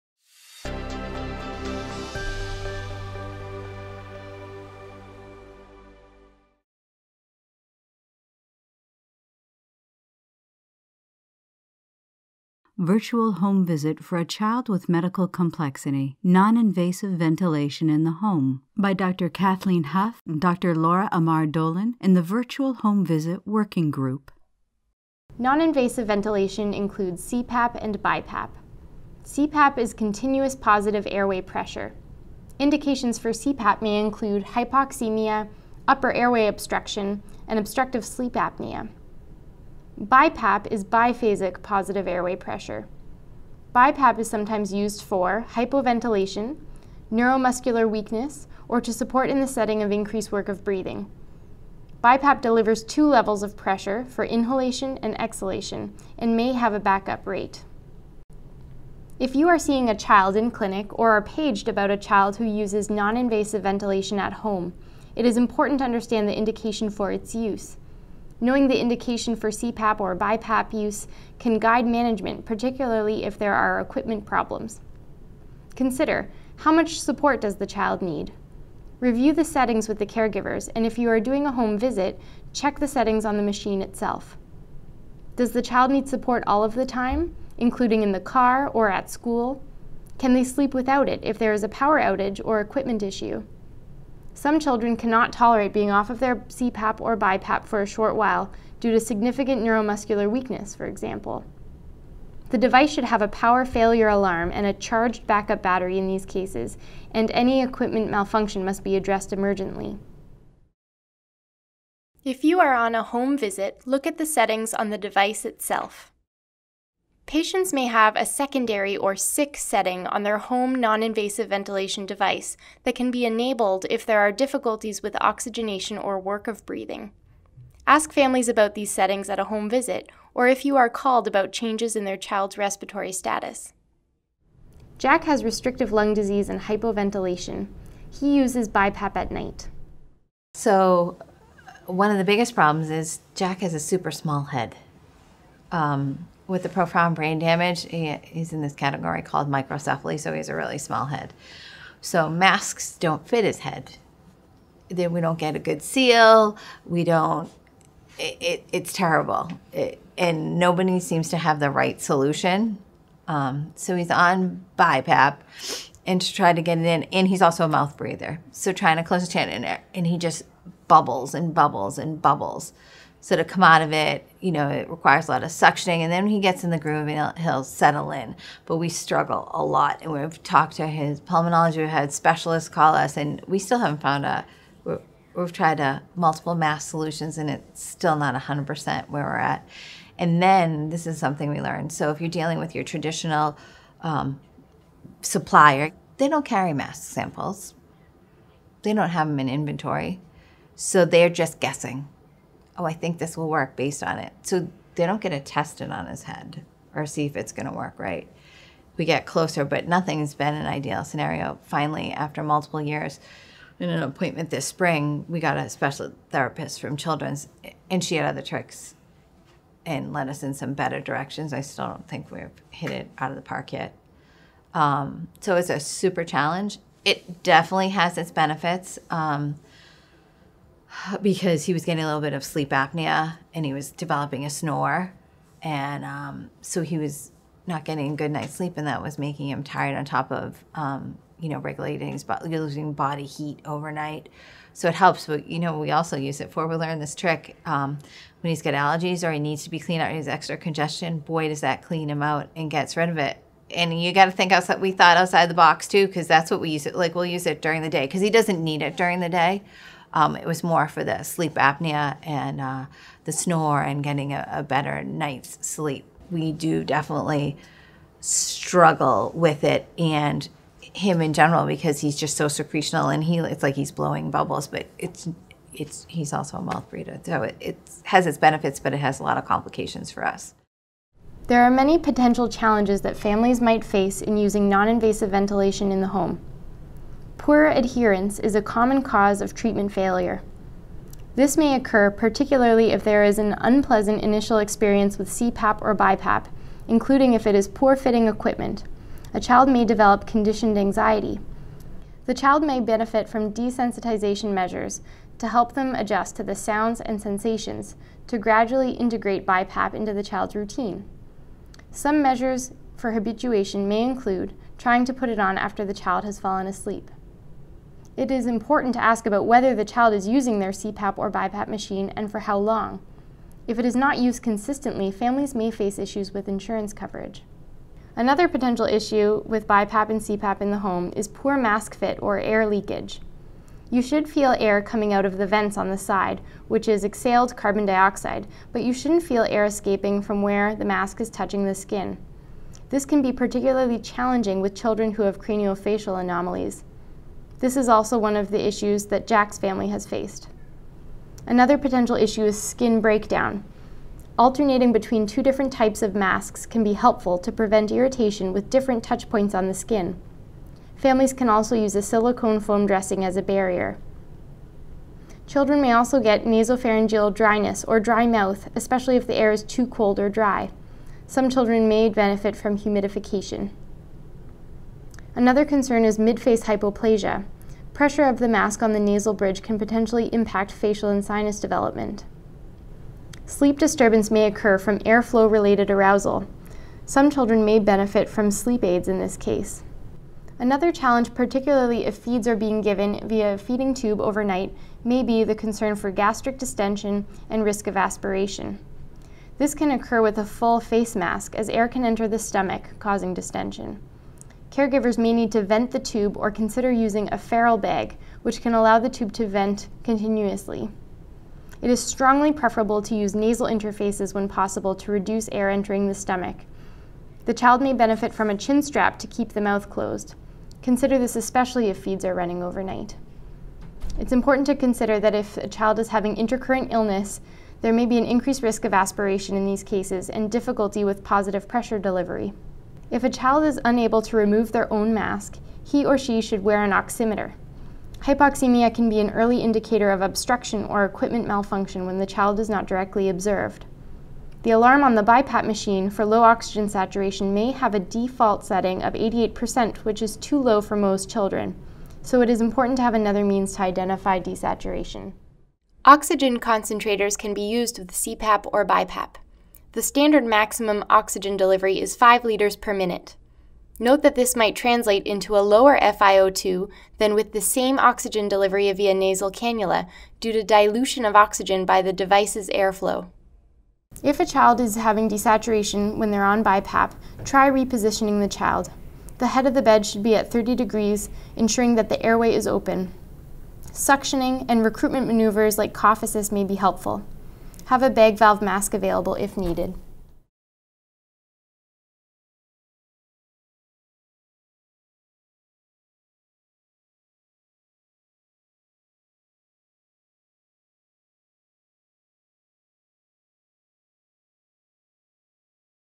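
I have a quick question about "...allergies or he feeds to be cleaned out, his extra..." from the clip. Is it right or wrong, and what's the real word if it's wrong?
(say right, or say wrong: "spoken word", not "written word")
wrong: "needs", not "feeds".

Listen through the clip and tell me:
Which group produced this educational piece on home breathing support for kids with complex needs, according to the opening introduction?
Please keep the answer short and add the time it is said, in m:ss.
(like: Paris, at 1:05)
Virtual Home Visit Working Group, at 0:22.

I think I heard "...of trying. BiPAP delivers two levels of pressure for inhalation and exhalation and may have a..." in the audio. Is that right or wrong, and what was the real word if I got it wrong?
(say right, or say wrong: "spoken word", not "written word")
wrong: "breathing", not "trying".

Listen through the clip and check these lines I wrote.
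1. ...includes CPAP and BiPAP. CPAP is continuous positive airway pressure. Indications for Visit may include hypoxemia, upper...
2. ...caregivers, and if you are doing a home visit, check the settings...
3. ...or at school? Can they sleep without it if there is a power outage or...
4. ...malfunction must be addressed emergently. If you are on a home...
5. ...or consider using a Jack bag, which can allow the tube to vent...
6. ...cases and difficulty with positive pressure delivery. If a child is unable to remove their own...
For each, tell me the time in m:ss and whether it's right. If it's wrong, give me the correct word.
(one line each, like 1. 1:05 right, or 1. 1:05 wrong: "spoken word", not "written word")
1. 0:26 wrong: "CPAP", not "Visit"
2. 1:20 right
3. 1:28 right
4. 1:48 right
5. 6:46 wrong: "Farrell", not "Jack"
6. 7:09 right.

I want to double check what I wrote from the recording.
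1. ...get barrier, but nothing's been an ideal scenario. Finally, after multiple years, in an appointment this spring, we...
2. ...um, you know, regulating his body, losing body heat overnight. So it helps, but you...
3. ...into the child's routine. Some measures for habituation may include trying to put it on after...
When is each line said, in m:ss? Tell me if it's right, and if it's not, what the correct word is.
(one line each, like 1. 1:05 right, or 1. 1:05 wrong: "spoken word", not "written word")
1. 3:29 wrong: "closer", not "barrier"
2. 4:00 right
3. 5:09 right.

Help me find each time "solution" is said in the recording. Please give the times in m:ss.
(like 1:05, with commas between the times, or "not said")
2:42, 3:06.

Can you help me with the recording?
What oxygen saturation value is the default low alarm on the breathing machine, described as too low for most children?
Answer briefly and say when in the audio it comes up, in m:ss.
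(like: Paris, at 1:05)
88%, at 7:29.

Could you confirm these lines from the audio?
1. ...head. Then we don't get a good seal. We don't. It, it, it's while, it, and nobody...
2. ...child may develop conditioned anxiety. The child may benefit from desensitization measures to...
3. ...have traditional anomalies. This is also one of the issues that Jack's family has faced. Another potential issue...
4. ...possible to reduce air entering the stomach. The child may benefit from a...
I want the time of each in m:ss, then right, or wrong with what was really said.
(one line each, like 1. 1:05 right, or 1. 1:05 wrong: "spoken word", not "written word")
1. 2:33 wrong: "terrible", not "while"
2. 4:59 right
3. 5:45 wrong: "craniofacial", not "traditional"
4. 6:54 right.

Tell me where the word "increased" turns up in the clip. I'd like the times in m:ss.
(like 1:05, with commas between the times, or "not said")
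0:49, 7:08.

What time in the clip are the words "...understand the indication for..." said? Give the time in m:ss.
1:05.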